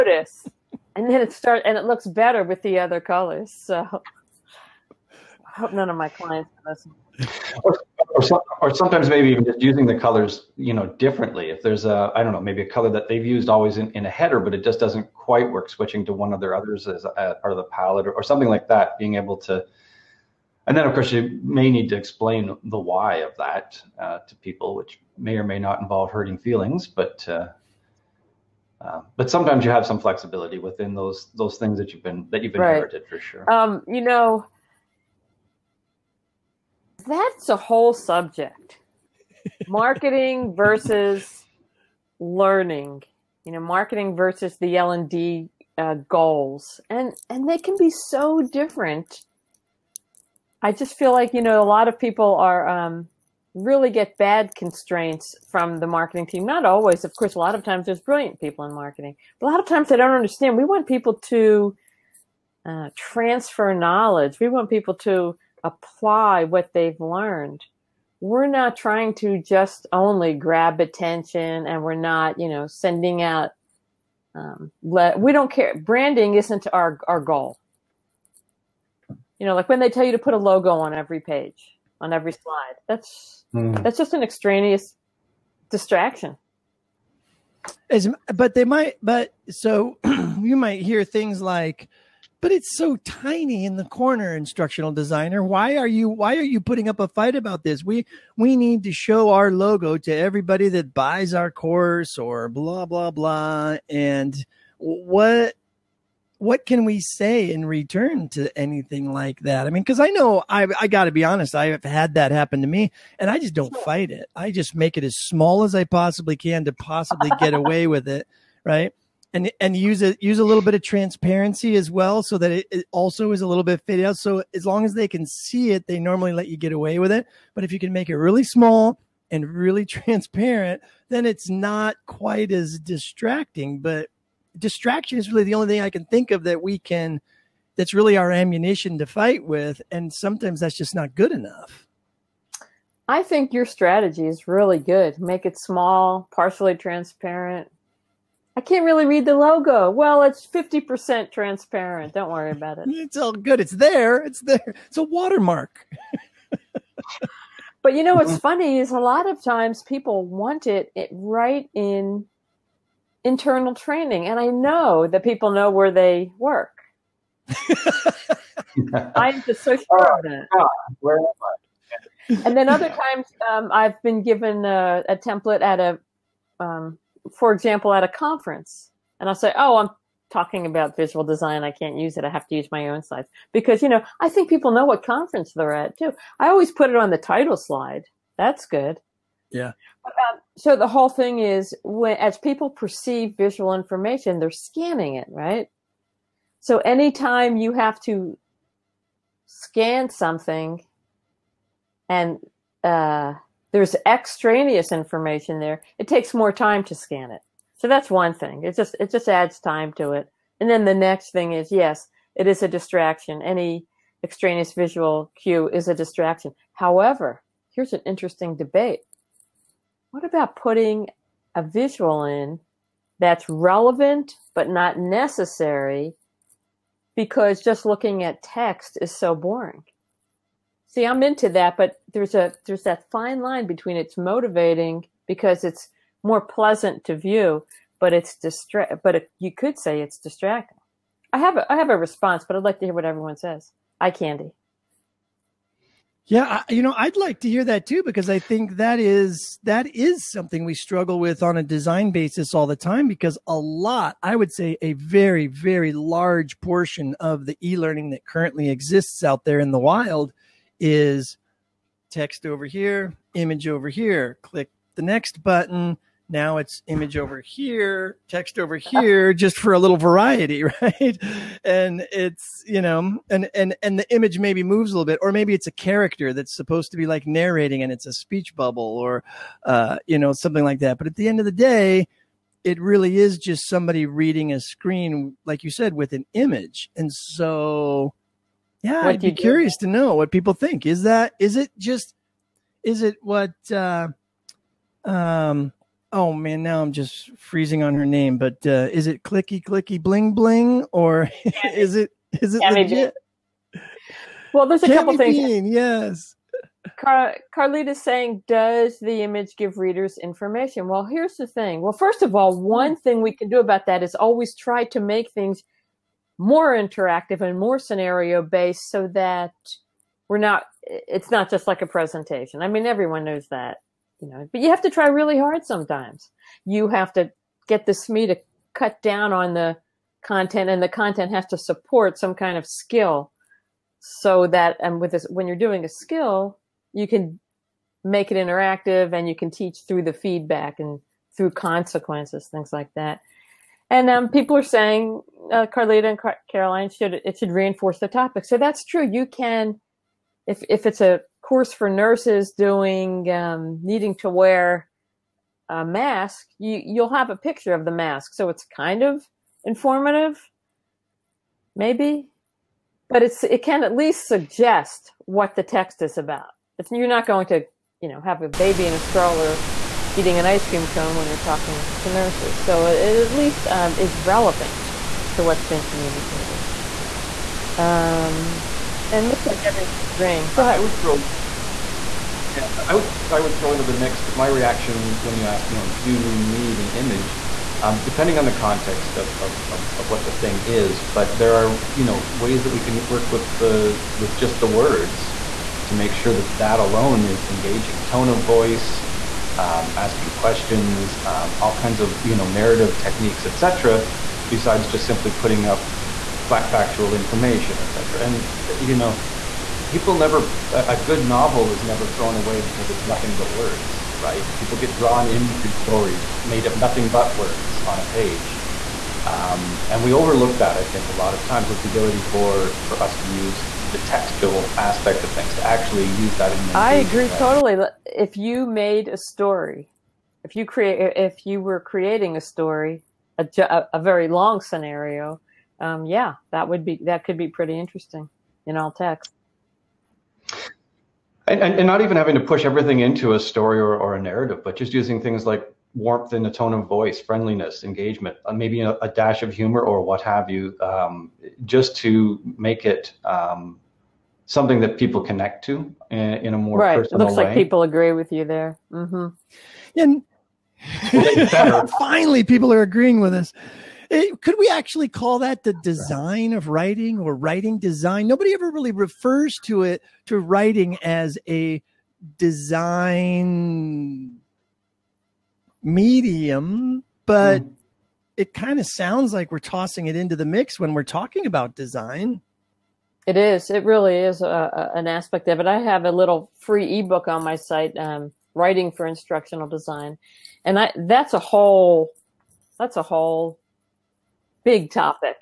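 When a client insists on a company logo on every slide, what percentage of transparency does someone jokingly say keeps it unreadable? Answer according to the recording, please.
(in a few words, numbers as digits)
50%.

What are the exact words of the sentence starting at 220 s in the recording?
What about putting a visual in that's relevant but not necessary because just looking at text is so boring?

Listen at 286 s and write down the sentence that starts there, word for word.
And so yeah, what I'd be curious to know what people think.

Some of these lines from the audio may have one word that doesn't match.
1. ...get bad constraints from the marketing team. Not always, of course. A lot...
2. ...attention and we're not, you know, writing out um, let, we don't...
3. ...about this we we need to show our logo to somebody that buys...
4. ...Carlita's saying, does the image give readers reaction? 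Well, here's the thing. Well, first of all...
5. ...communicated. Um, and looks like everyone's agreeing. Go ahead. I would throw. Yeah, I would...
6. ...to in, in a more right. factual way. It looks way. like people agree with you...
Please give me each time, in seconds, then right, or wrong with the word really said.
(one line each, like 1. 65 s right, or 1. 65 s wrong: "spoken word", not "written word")
1. 53 s right
2. 70 s wrong: "sending", not "writing"
3. 97 s wrong: "everybody", not "somebody"
4. 307 s wrong: "information", not "reaction"
5. 375 s right
6. 455 s wrong: "personal", not "factual".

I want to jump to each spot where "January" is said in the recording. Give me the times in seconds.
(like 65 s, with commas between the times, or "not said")
not said.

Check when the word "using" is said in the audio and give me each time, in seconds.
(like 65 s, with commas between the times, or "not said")
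9 s, 444 s.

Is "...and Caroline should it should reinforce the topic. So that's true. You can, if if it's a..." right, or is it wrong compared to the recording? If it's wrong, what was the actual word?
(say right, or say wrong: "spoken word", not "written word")
right.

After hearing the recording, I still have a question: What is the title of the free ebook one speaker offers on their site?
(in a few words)
Writing for Instructional Design.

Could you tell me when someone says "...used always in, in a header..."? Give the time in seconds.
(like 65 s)
13 s.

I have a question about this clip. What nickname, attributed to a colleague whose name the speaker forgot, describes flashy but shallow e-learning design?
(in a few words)
clicky clicky bling bling.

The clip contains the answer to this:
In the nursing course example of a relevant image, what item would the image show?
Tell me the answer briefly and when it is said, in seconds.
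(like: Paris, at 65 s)
a mask, at 357 s.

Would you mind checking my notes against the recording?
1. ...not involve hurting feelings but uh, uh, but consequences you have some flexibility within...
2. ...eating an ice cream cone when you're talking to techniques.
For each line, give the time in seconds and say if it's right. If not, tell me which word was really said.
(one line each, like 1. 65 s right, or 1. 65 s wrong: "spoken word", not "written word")
1. 25 s wrong: "sometimes", not "consequences"
2. 370 s wrong: "nurses", not "techniques".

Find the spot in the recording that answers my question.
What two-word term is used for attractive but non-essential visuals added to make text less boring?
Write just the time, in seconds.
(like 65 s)
243 s.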